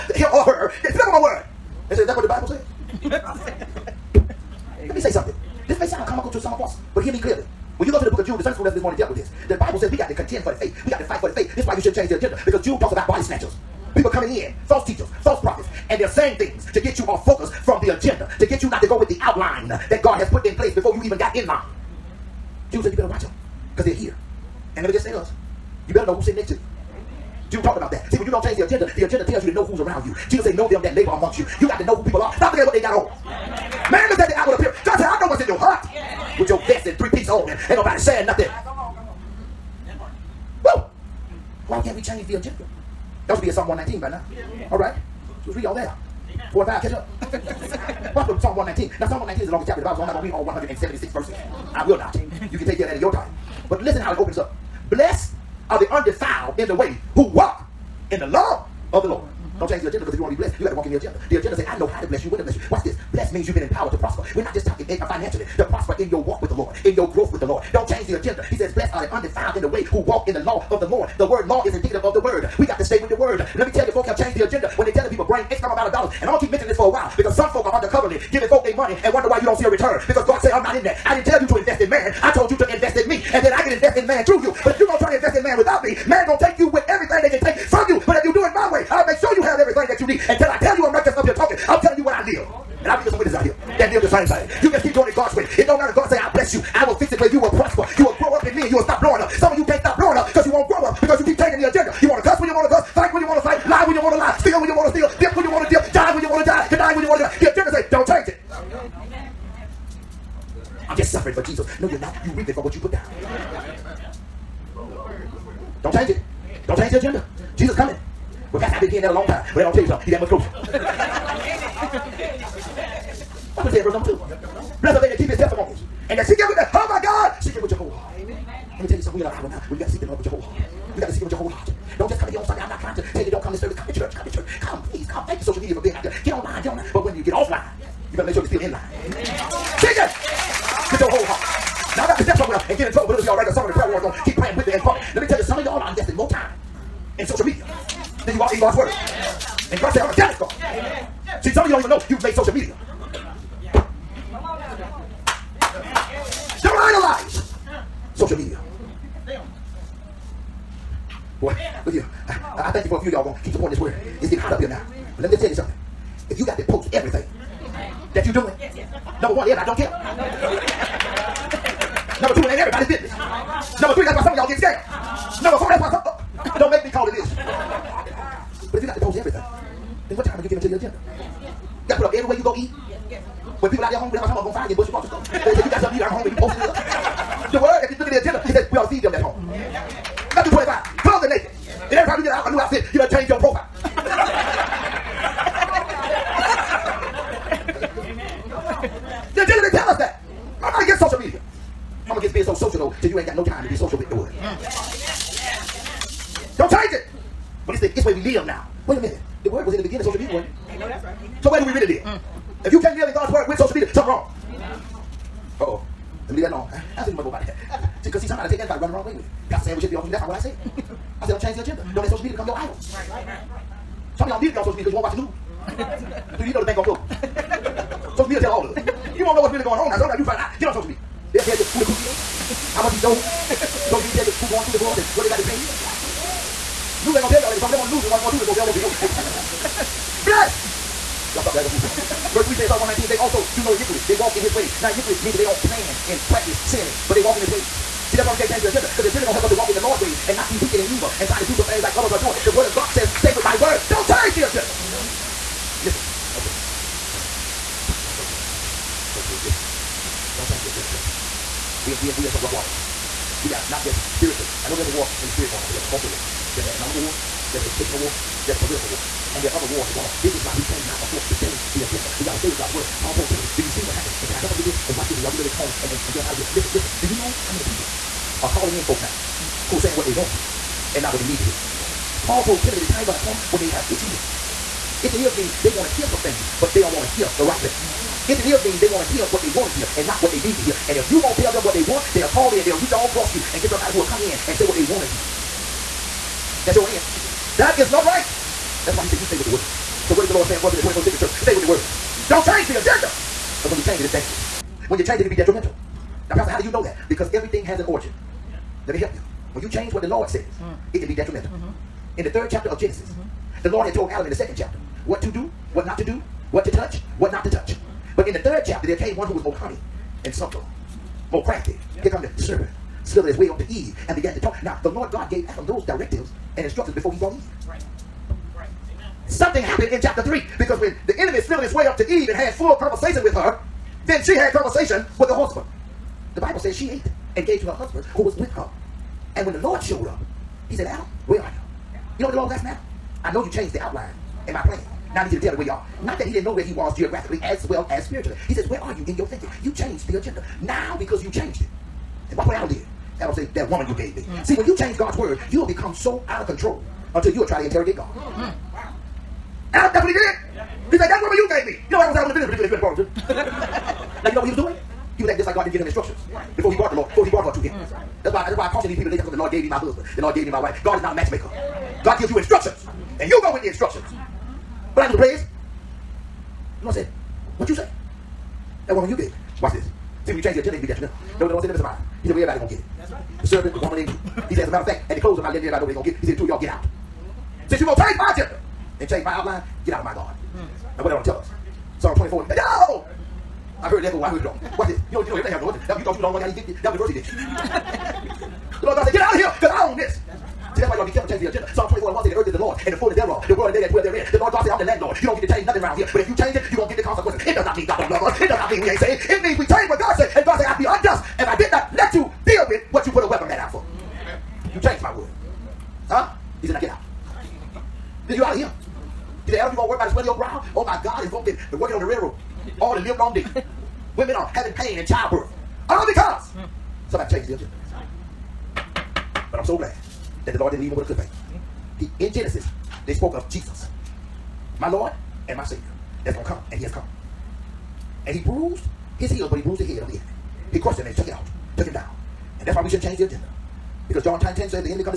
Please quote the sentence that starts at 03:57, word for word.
News ain't gonna tell y'all that because some of them on the news is the ones going through the divorce.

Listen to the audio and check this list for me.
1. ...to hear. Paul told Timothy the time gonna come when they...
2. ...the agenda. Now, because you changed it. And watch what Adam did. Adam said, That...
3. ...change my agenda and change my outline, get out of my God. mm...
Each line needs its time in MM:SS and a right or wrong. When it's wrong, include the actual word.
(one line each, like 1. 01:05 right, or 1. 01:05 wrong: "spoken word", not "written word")
1. 04:41 right
2. 05:50 right
3. 06:27 right.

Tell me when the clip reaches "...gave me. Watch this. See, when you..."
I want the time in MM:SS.
06:19.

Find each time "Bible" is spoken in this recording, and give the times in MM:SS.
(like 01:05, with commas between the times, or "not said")
00:02, 00:09, 00:49, 05:36.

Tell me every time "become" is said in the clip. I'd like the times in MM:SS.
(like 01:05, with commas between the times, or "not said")
03:42, 05:55.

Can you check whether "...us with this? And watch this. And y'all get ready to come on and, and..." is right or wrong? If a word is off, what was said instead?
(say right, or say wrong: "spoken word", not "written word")
right.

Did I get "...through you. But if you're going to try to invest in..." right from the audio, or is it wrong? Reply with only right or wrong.
right.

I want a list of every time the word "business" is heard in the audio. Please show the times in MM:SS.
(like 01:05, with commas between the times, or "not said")
02:52, 06:02.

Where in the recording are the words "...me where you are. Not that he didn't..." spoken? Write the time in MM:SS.
05:45.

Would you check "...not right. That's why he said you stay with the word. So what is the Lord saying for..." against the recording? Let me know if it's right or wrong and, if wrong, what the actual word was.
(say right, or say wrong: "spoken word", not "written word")
right.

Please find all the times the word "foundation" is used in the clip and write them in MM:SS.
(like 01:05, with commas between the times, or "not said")
not said.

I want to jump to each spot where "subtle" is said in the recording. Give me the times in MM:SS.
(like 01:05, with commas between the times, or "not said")
05:20.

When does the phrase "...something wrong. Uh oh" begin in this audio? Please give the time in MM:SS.
03:33.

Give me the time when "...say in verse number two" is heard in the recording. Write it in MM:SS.
02:03.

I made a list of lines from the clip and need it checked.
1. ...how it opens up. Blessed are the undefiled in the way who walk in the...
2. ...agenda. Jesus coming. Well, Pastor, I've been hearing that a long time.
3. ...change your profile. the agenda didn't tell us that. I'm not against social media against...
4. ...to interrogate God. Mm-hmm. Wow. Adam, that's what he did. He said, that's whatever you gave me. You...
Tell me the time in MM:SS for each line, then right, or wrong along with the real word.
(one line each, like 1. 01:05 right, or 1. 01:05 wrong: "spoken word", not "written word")
1. 00:54 right
2. 01:56 right
3. 03:13 right
4. 05:57 right.